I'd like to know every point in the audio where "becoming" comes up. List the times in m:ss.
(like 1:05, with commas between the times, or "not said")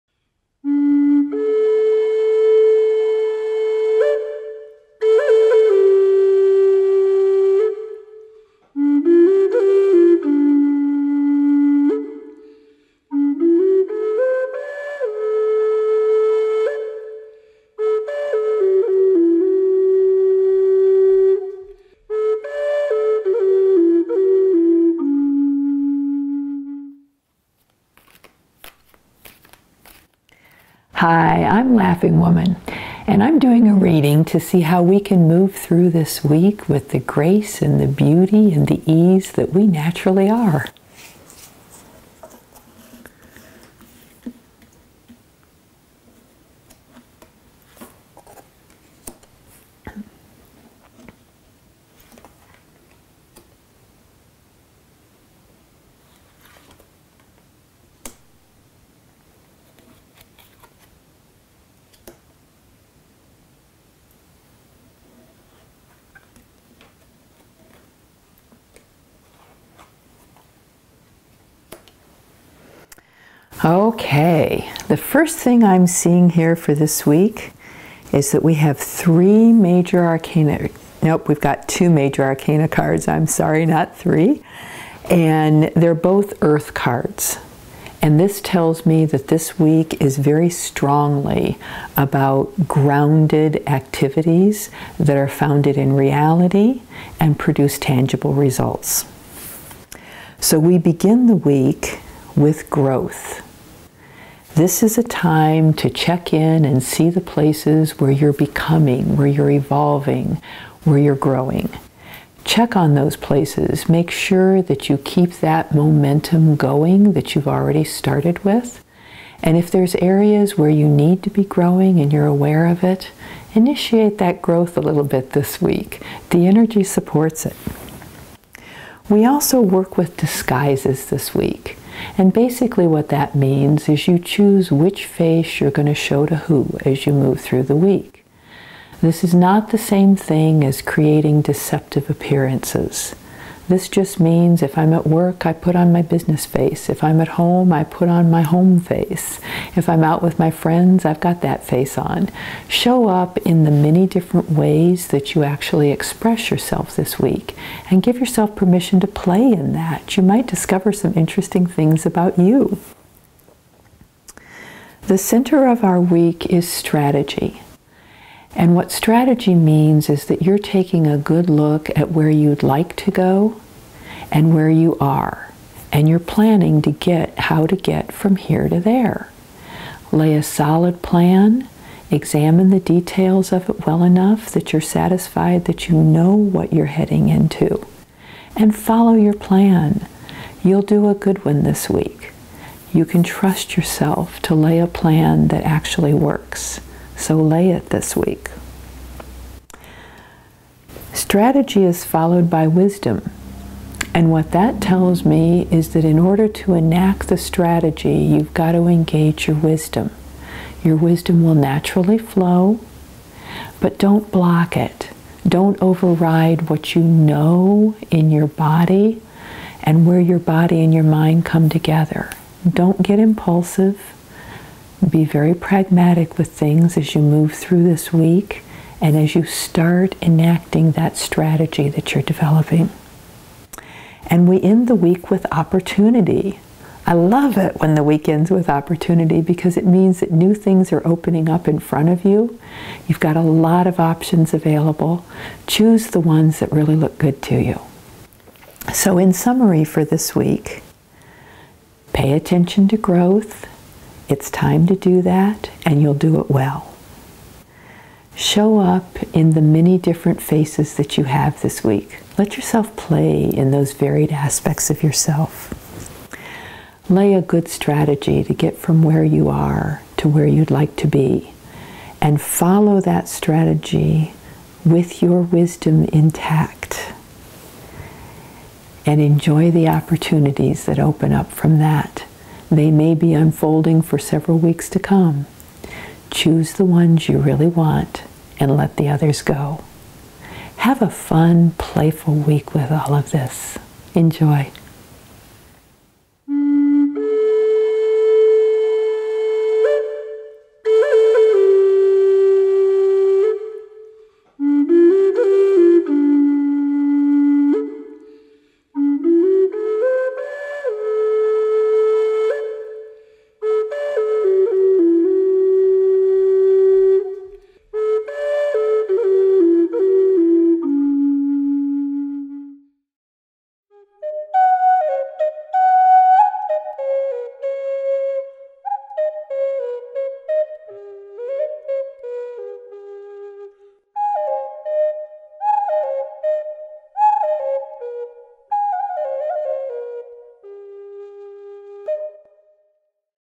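1:48.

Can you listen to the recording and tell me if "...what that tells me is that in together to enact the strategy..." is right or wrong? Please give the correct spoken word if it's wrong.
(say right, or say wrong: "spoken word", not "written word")
wrong: "order", not "together".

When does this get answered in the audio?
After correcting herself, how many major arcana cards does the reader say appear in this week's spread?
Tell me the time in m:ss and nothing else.
1:21.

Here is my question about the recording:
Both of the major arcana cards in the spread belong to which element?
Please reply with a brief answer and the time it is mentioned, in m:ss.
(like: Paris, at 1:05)
Earth, at 1:26.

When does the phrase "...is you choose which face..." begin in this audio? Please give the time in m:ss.
2:13.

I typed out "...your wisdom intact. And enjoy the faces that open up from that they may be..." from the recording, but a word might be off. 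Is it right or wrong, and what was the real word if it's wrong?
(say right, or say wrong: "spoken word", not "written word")
wrong: "opportunities", not "faces".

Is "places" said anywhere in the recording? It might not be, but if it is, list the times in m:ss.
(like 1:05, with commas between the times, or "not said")
1:47, 1:53.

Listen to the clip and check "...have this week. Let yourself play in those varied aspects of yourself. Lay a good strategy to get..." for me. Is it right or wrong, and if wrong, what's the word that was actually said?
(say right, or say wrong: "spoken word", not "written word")
right.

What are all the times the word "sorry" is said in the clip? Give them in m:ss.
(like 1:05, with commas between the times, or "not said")
1:23.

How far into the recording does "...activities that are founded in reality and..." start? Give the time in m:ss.
1:33.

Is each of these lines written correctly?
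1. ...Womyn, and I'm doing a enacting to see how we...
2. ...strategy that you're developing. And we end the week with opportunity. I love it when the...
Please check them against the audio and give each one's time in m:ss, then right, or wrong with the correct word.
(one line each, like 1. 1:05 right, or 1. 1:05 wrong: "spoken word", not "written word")
1. 0:32 wrong: "reading", not "enacting"
2. 3:51 right.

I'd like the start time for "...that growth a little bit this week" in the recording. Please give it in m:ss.
2:04.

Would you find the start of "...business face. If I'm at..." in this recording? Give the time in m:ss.
2:26.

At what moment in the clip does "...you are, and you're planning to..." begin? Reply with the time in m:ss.
2:54.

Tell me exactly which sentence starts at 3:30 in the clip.
Your wisdom will naturally flow, but don't block it.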